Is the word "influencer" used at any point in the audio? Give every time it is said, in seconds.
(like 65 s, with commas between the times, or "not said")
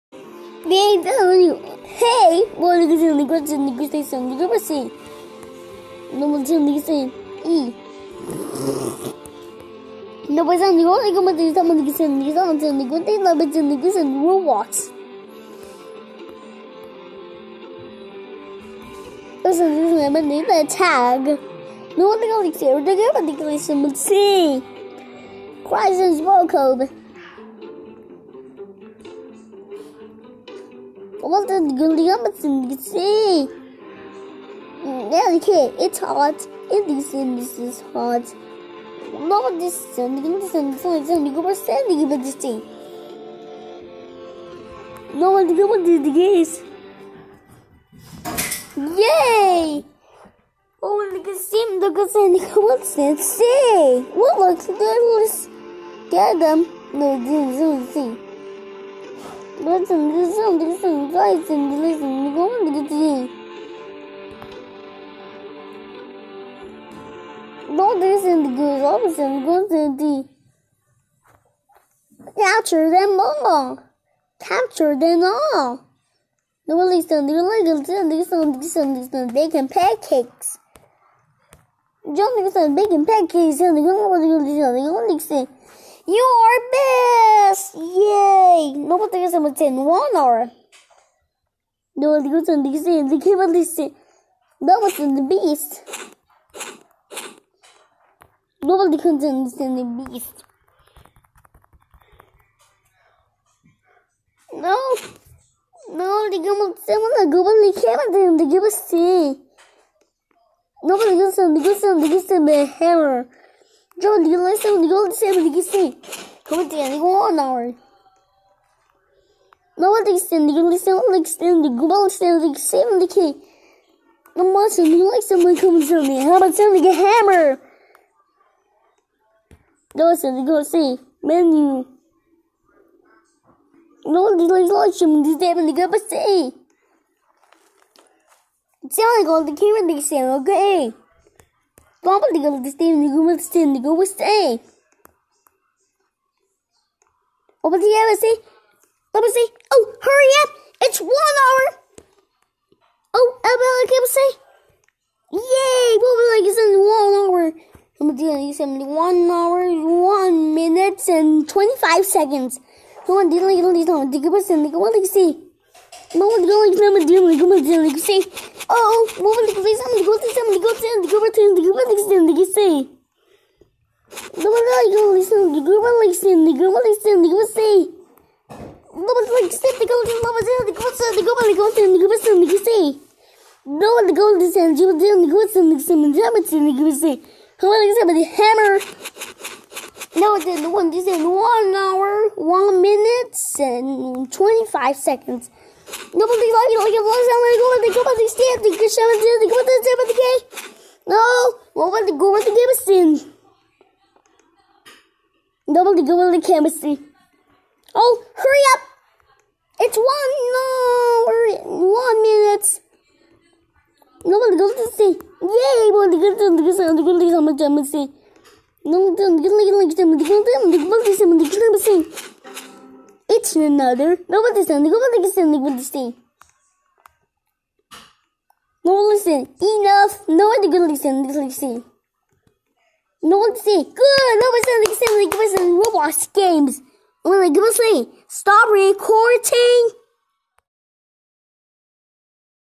not said.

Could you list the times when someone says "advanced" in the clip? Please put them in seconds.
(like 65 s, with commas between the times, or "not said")
not said.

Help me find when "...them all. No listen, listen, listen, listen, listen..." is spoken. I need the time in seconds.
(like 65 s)
74 s.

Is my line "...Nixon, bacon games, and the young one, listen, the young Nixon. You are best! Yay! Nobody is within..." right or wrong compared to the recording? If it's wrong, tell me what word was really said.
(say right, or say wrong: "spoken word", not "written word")
wrong: "pancakes", not "games".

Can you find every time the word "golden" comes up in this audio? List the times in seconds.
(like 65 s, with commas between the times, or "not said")
179 s, 184 s.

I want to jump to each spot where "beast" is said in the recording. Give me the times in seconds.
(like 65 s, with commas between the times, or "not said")
95 s, 100 s.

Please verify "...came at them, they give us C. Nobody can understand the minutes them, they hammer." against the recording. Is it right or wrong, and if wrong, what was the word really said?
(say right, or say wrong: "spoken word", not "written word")
wrong: "gives", not "minutes".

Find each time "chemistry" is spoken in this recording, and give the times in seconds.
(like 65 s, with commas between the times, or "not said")
206 s, 217 s.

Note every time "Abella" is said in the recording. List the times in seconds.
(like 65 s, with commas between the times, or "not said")
153 s.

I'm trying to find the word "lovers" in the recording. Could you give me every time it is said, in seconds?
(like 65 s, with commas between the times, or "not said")
180 s.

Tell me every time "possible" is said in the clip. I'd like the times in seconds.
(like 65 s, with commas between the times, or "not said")
not said.